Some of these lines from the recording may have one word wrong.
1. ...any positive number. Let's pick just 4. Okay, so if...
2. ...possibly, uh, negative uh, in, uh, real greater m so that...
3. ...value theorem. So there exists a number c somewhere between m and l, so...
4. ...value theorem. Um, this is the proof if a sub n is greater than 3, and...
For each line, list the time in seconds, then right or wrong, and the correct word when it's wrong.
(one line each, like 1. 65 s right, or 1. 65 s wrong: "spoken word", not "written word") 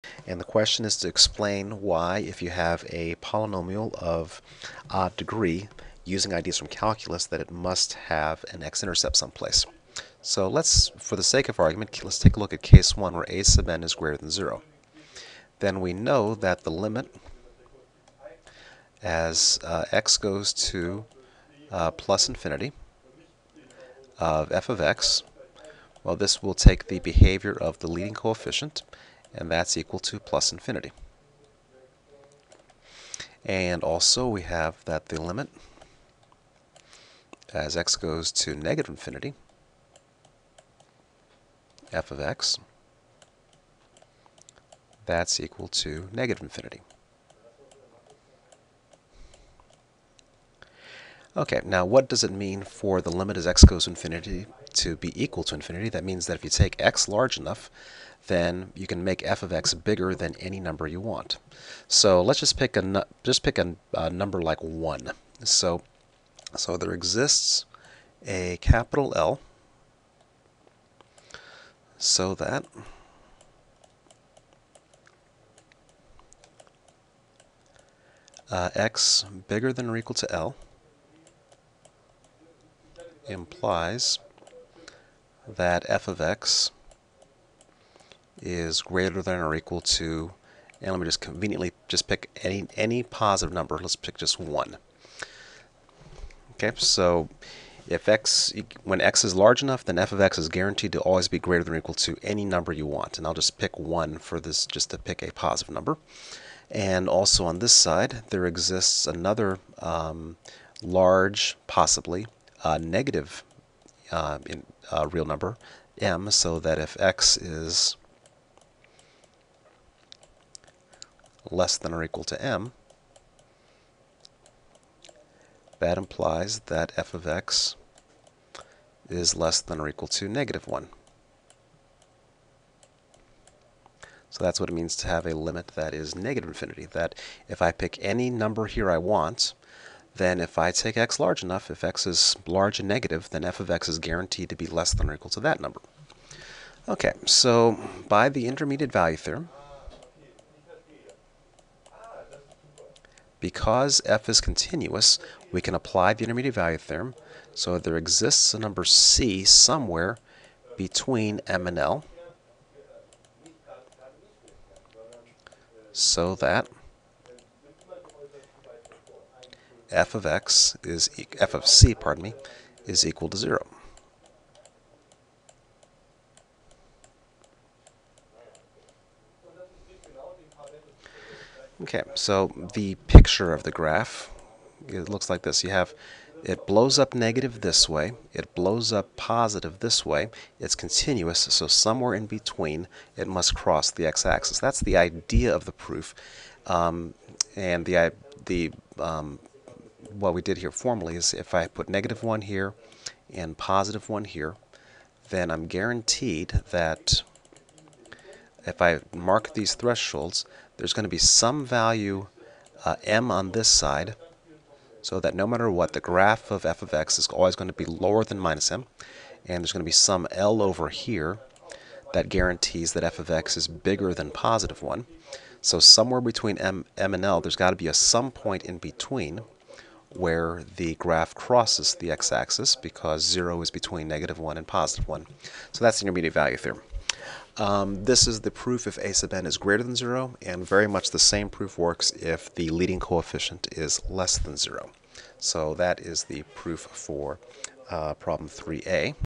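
1. 92 s wrong: "1", not "4"
2. 111 s wrong: "number", not "greater"
3. 156 s right
4. 236 s wrong: "0", not "3".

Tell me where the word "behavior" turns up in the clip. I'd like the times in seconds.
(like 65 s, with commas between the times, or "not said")
26 s.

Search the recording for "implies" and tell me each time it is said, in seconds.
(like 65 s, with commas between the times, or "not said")
83 s, 125 s.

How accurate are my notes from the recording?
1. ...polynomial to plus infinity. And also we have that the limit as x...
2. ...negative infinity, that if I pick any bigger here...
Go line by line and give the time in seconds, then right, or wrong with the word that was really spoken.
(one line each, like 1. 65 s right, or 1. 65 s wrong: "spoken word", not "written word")
1. 29 s wrong: "equal", not "polynomial"
2. 136 s wrong: "number", not "bigger".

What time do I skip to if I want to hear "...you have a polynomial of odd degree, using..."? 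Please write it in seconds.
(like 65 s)
2 s.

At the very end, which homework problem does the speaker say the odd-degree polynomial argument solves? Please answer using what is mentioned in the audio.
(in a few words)
3a.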